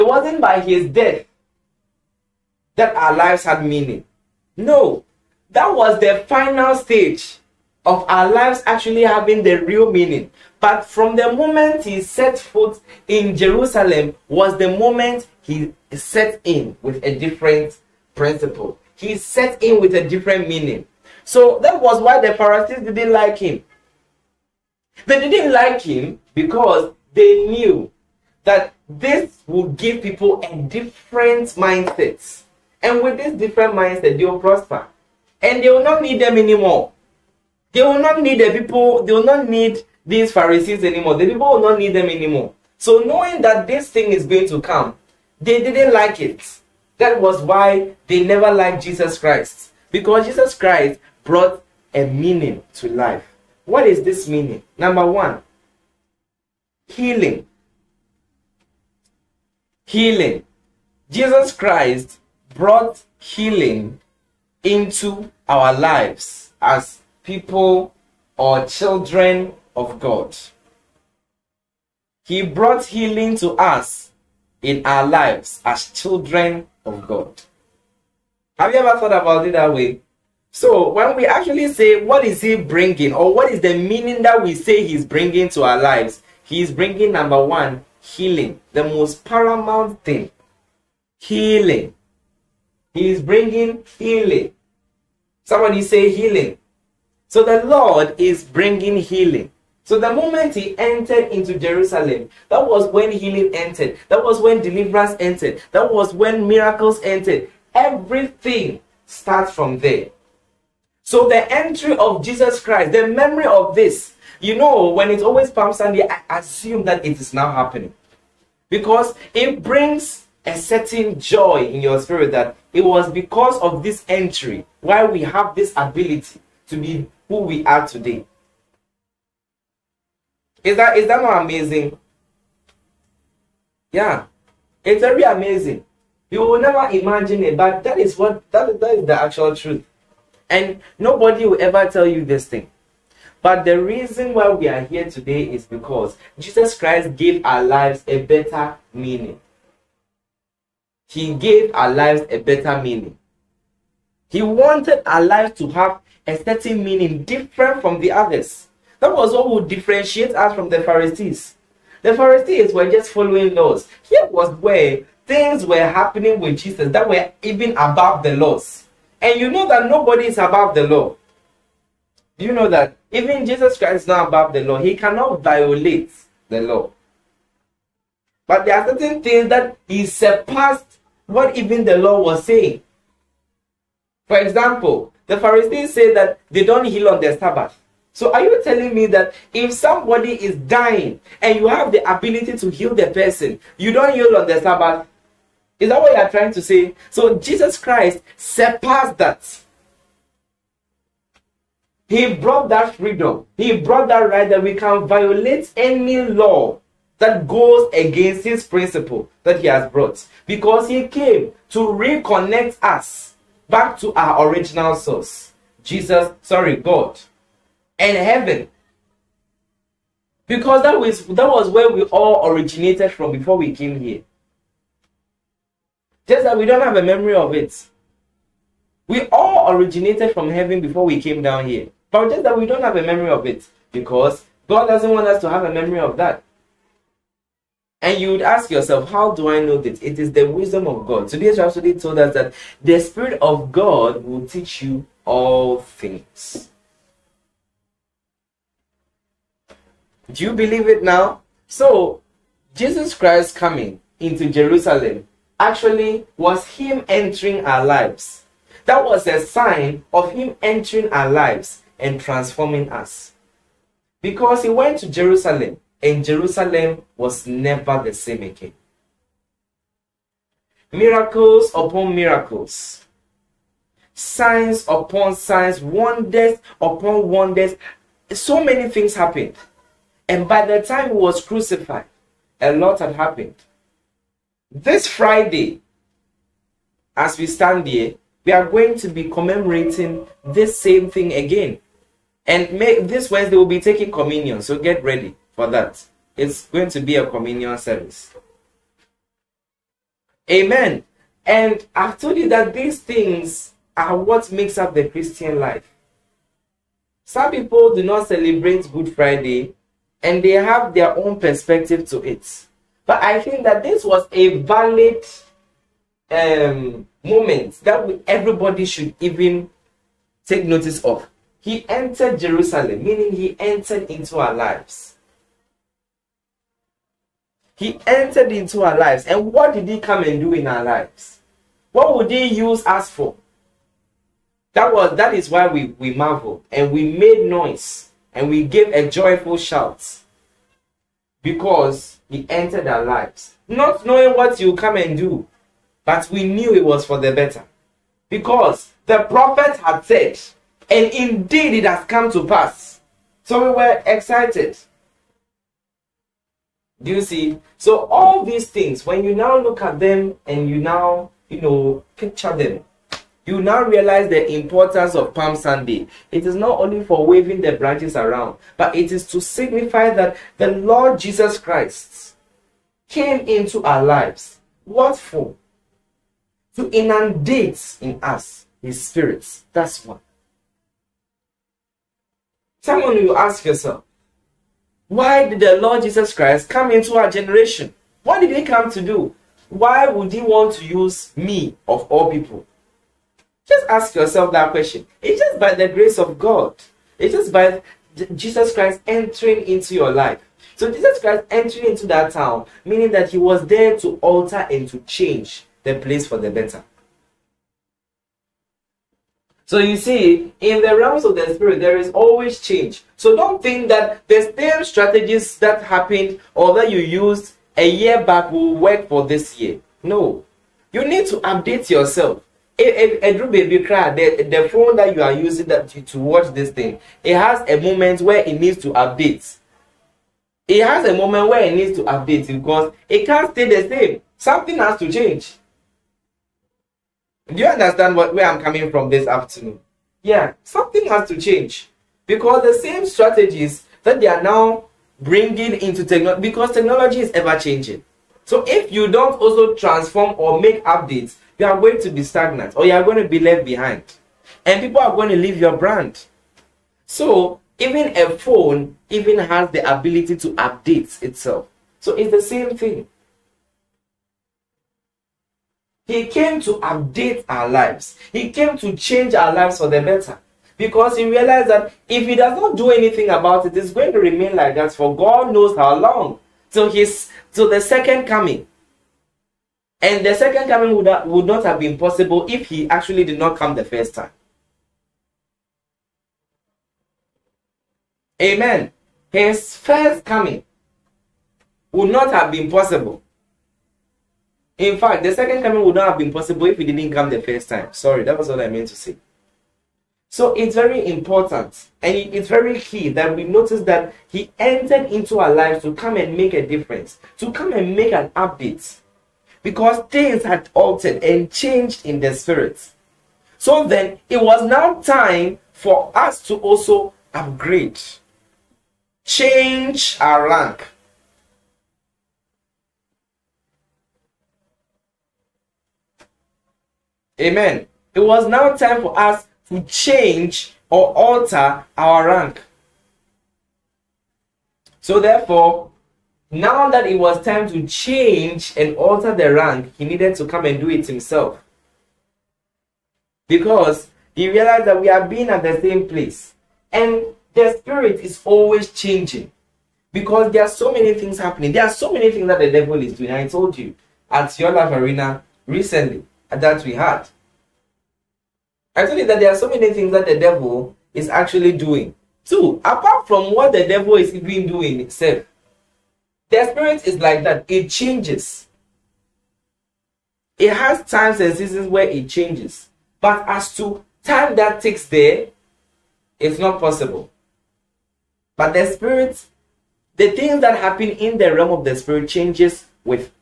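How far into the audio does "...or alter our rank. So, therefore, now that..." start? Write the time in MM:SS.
08:50.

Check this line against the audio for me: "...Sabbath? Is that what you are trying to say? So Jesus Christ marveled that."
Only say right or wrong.
wrong.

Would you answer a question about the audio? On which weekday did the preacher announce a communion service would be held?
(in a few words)
Wednesday.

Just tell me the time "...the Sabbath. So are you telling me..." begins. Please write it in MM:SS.
03:07.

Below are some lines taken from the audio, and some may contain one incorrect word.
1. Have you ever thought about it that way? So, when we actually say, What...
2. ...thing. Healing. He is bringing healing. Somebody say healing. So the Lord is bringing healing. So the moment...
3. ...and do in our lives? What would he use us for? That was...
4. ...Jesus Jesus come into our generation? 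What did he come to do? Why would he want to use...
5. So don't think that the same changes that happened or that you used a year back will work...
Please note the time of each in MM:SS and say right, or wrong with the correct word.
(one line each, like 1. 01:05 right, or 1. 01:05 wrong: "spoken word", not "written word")
1. 01:18 right
2. 01:30 right
3. 05:30 right
4. 06:26 wrong: "Christ", not "Jesus"
5. 06:53 wrong: "strategies", not "changes".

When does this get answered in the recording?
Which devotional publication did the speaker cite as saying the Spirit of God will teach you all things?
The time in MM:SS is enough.
04:01.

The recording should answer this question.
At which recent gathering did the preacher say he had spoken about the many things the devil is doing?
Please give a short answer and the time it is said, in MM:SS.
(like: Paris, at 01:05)
Life arena, at 09:14.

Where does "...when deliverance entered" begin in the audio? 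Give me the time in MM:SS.
01:44.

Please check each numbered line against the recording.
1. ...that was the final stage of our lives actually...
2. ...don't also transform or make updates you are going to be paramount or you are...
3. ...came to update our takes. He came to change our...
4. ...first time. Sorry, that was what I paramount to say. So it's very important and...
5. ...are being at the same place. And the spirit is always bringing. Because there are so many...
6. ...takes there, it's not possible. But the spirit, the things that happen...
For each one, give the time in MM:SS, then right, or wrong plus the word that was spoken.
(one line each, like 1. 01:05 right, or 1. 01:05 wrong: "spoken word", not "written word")
1. 00:05 right
2. 07:29 wrong: "stagnant", not "paramount"
3. 07:46 wrong: "lives", not "takes"
4. 08:17 wrong: "meant", not "paramount"
5. 09:05 wrong: "changing", not "bringing"
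6. 09:34 right.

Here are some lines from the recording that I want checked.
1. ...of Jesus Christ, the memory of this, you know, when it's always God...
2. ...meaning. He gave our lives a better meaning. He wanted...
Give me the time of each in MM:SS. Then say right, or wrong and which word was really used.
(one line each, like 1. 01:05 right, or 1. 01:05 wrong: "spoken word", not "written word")
1. 01:51 wrong: "Palm", not "God"
2. 02:28 right.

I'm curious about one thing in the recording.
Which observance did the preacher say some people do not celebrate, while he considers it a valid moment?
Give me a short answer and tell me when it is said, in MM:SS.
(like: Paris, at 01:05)
Good Friday, at 05:07.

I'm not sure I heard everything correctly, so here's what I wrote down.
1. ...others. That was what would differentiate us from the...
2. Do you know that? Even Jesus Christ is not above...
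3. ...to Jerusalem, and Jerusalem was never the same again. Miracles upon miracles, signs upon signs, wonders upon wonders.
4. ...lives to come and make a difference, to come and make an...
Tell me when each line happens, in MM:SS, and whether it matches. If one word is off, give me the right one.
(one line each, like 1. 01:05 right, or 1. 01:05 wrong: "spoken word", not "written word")
1. 02:38 right
2. 02:52 right
3. 04:25 right
4. 08:25 right.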